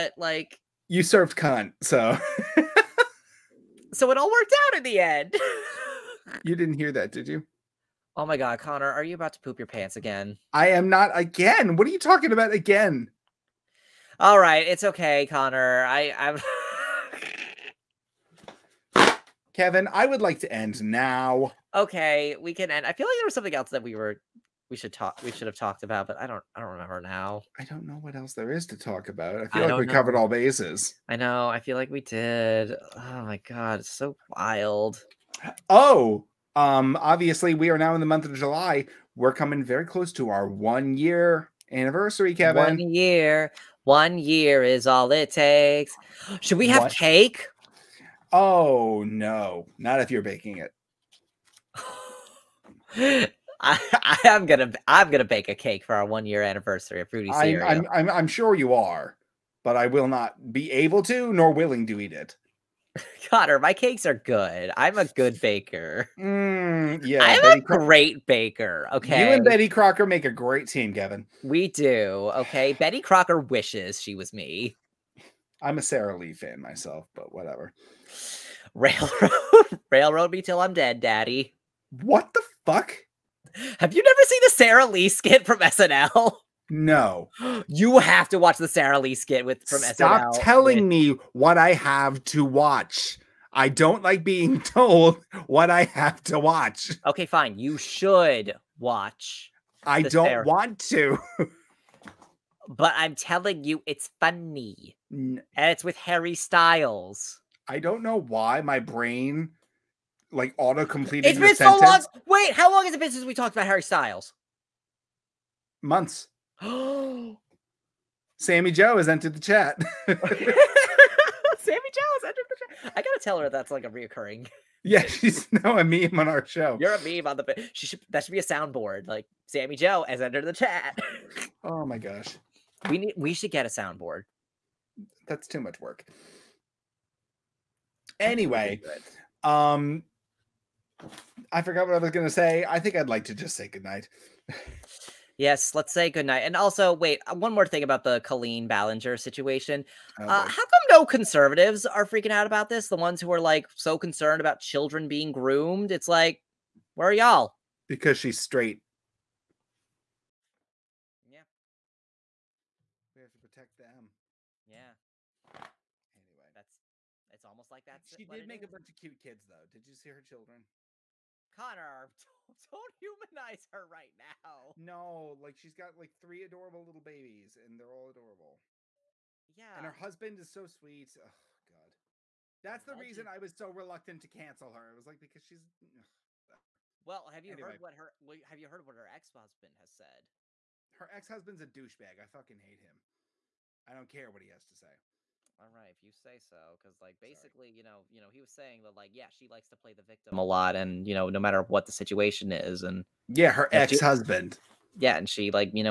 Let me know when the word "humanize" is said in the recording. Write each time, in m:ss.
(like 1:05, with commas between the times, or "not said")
2:53.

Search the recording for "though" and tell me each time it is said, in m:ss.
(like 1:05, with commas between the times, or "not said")
2:49.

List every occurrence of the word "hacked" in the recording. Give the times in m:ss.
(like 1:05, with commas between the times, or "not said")
not said.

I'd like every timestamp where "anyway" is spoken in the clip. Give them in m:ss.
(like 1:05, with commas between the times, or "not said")
2:18, 2:46, 3:07.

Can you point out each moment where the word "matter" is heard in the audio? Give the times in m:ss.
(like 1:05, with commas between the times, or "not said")
3:21.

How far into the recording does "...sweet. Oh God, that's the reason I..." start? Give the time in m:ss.
3:00.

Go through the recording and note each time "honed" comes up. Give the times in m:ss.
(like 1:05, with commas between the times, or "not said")
not said.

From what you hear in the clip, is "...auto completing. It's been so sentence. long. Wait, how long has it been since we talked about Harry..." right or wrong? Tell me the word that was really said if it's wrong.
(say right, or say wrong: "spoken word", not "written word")
right.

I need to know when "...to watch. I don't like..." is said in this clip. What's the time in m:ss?
1:32.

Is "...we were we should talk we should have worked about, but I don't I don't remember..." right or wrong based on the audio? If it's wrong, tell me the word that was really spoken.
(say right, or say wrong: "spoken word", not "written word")
wrong: "talked", not "worked".